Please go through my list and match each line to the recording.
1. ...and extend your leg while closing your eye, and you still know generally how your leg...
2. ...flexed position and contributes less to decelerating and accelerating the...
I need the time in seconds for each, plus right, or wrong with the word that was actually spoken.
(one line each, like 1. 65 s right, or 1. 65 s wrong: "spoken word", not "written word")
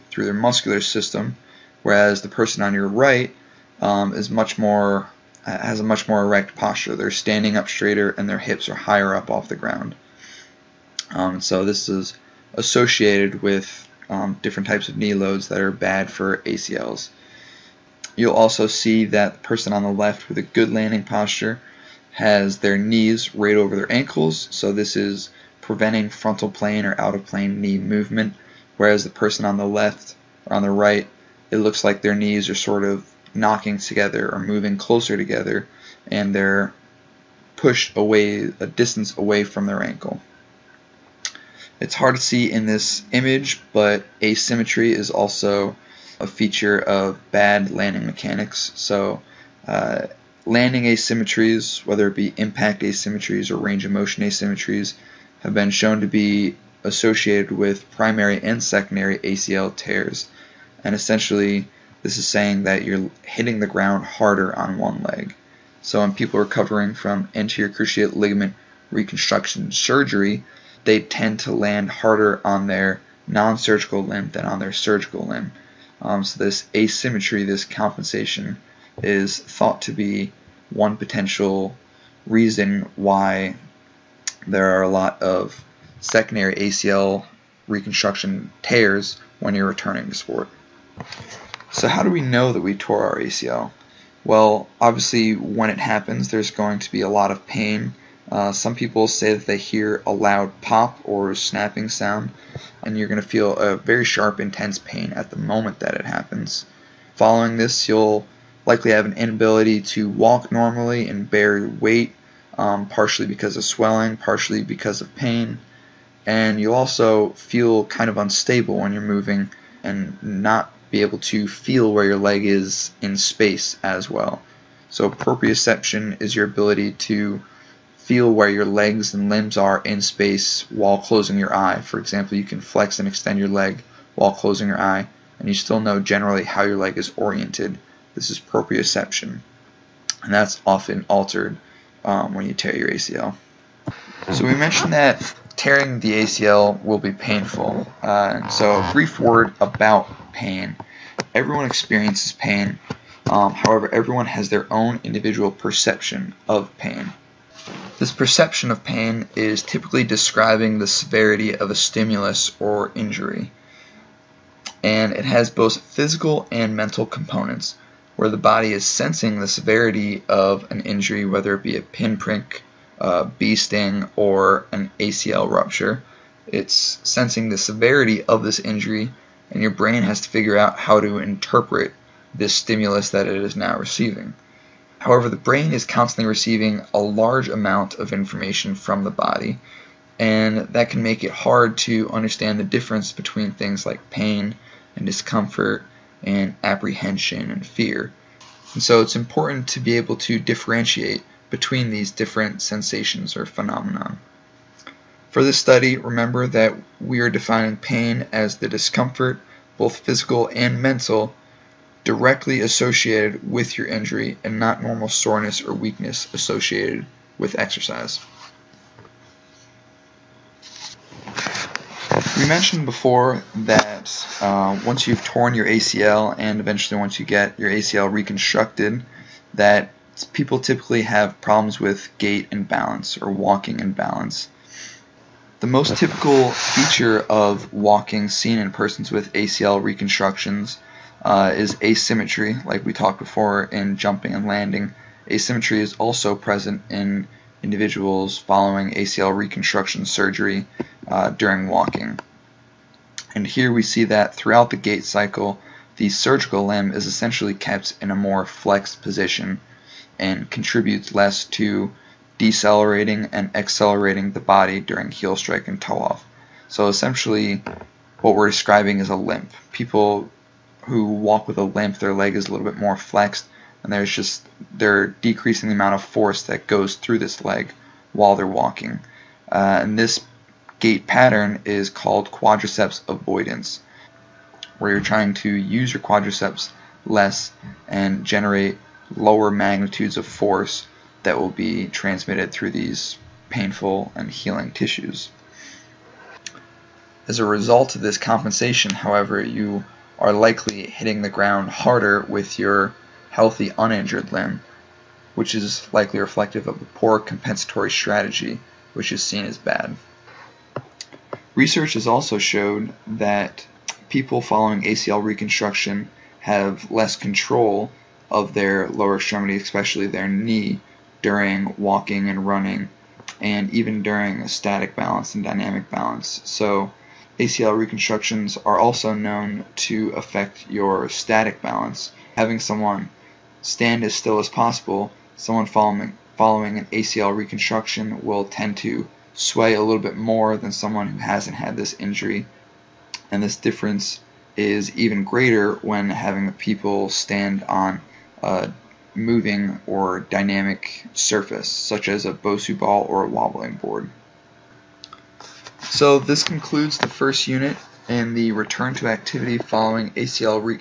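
1. 132 s right
2. 258 s right.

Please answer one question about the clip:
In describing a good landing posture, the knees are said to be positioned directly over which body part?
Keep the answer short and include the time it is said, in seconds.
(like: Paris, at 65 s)
Ankles, at 23 s.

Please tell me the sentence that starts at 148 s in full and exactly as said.
Uh, so a brief word about pain.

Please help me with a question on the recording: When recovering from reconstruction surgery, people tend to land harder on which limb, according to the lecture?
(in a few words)
Non-surgical limb.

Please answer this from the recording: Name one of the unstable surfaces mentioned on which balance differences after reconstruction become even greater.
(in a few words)
Bosu ball.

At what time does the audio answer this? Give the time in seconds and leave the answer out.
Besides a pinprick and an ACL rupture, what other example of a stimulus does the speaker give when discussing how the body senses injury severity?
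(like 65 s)
172 s.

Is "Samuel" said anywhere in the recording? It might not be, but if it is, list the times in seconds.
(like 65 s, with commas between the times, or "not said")
not said.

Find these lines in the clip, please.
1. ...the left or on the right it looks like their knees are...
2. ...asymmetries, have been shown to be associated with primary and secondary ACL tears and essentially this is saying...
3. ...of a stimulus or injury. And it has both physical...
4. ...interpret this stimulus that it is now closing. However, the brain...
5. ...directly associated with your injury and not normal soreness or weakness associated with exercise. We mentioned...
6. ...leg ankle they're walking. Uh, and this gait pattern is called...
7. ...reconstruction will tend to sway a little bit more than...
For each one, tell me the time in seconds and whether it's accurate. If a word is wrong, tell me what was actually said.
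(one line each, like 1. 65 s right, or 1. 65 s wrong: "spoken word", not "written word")
1. 29 s right
2. 54 s right
3. 161 s right
4. 181 s wrong: "receiving", not "closing"
5. 212 s right
6. 277 s wrong: "while", not "ankle"
7. 337 s right.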